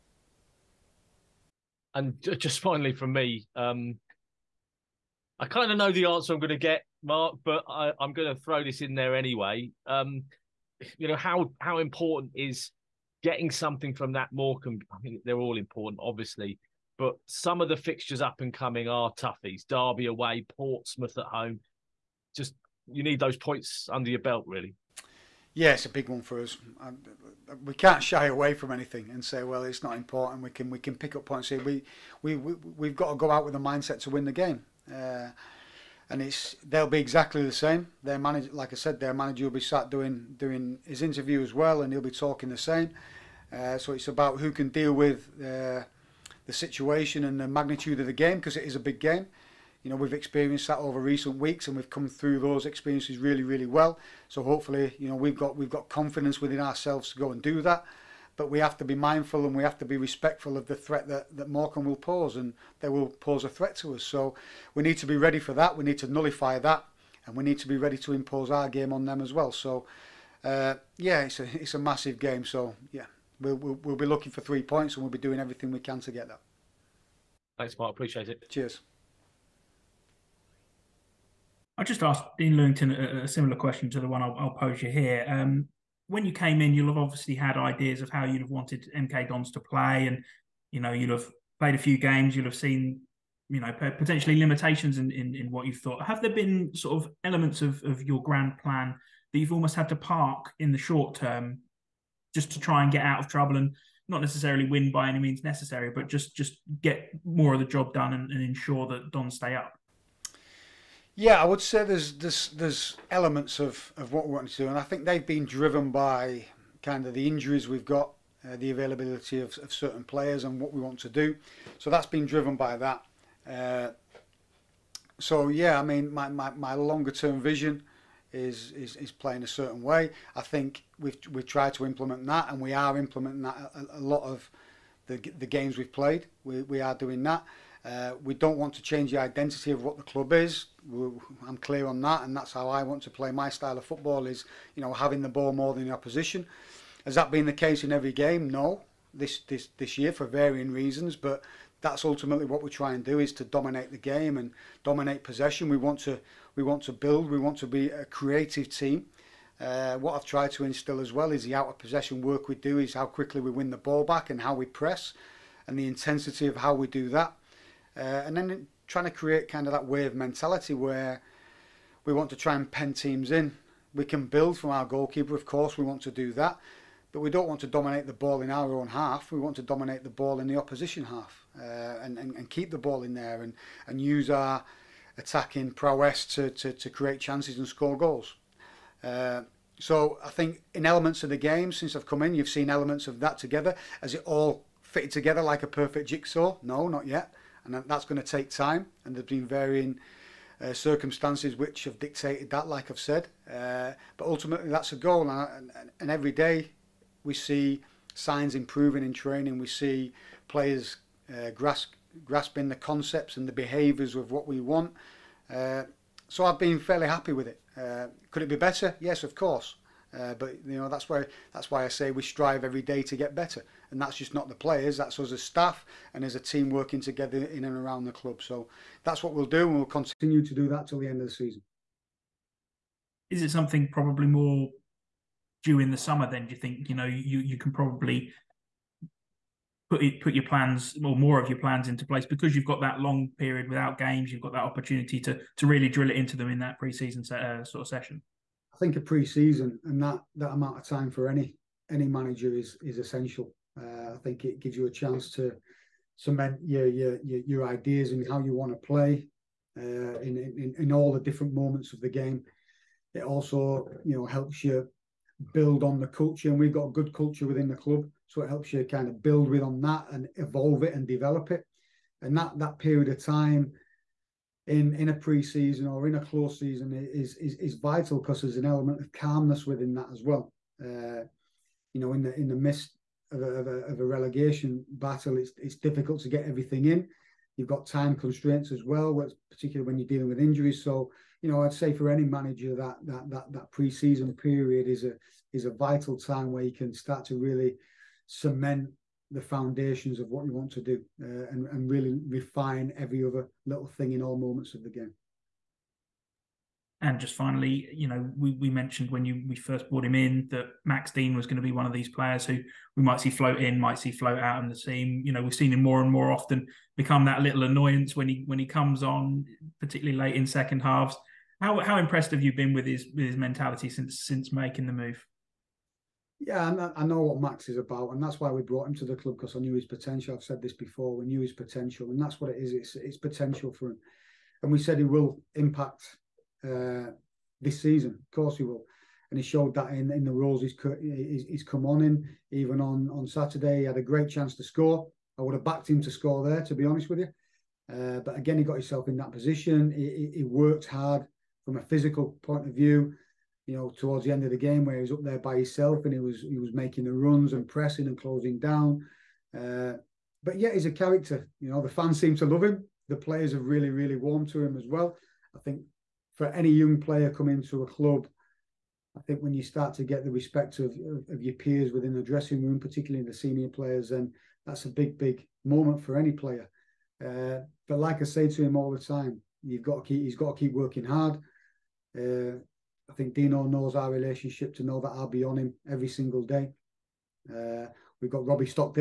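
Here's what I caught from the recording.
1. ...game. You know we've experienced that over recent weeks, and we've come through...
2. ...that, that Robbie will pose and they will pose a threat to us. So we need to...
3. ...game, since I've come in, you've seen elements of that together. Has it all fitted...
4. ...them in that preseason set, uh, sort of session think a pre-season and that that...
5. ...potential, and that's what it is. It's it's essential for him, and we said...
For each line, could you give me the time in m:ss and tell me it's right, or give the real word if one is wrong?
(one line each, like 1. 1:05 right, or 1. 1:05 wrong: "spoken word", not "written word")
1. 0:48 right
2. 1:01 wrong: "Morecambe", not "Robbie"
3. 3:11 right
4. 4:06 right
5. 5:31 wrong: "potential", not "essential".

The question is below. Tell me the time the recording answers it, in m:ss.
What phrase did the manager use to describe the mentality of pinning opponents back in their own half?
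2:49.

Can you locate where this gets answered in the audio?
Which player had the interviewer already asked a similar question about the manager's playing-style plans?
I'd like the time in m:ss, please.
1:22.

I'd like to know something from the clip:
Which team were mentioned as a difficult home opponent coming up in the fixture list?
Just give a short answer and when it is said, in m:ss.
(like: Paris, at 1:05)
Portsmouth, at 0:20.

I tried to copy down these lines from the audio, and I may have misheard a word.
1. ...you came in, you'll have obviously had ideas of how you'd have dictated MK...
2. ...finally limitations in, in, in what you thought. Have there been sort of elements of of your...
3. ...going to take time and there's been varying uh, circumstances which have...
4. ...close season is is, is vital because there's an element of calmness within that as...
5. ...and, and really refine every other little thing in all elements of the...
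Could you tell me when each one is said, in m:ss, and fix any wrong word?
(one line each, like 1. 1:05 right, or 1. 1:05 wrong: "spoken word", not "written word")
1. 1:26 wrong: "wanted", not "dictated"
2. 1:33 wrong: "potentially", not "finally"
3. 3:18 right
4. 4:36 right
5. 5:01 wrong: "moments", not "elements".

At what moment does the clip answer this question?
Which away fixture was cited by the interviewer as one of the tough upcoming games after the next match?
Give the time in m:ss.
0:19.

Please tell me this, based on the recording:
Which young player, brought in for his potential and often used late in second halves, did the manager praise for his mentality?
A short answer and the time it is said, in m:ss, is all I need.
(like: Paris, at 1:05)
Max Dean, at 5:10.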